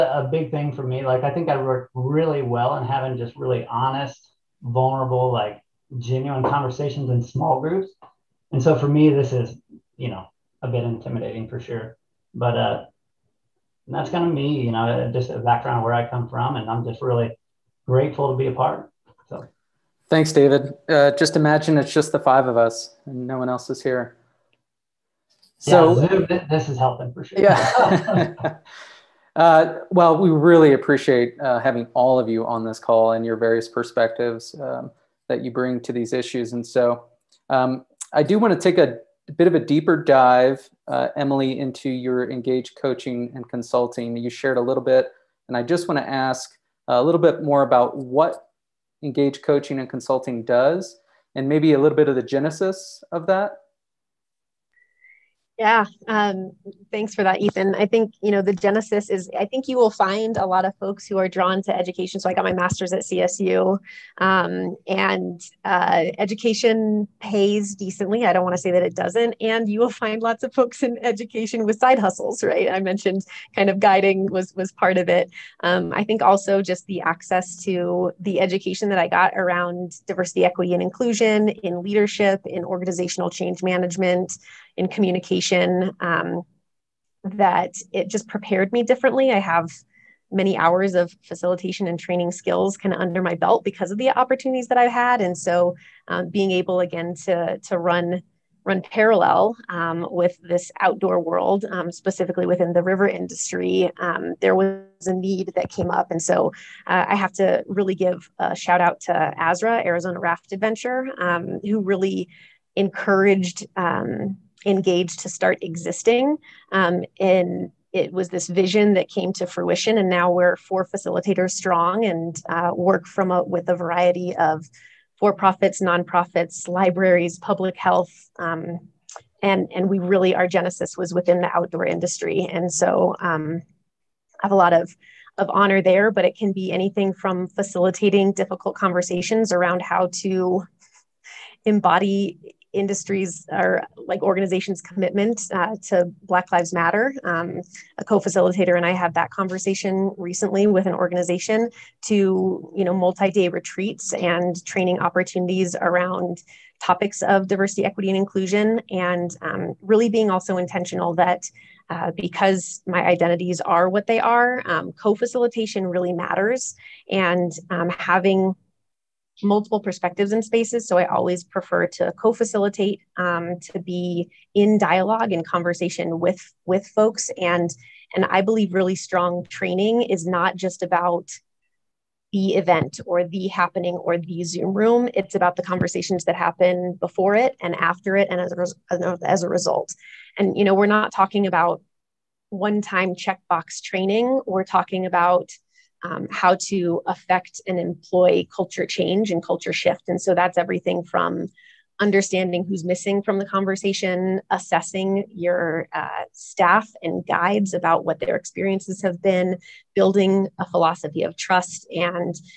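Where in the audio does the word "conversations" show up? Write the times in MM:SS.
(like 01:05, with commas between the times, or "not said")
00:06, 02:18, 02:29, 02:55, 03:05, 03:23.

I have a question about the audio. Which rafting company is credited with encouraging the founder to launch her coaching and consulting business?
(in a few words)
Arizona Raft Adventure.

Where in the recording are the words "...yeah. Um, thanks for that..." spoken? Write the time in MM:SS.
00:55.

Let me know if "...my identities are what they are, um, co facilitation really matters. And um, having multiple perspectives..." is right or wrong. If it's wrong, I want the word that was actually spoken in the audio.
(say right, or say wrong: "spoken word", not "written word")
right.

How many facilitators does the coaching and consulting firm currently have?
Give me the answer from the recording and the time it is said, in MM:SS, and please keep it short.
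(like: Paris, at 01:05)
4, at 02:00.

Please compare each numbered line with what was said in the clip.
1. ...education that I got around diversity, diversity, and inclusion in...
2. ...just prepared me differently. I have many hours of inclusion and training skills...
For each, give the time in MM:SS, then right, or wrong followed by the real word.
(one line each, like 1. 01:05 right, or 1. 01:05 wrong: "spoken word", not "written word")
1. 01:18 wrong: "equity", not "diversity"
2. 01:28 wrong: "facilitation", not "inclusion".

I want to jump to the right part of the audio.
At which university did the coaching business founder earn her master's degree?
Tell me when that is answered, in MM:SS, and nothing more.
01:03.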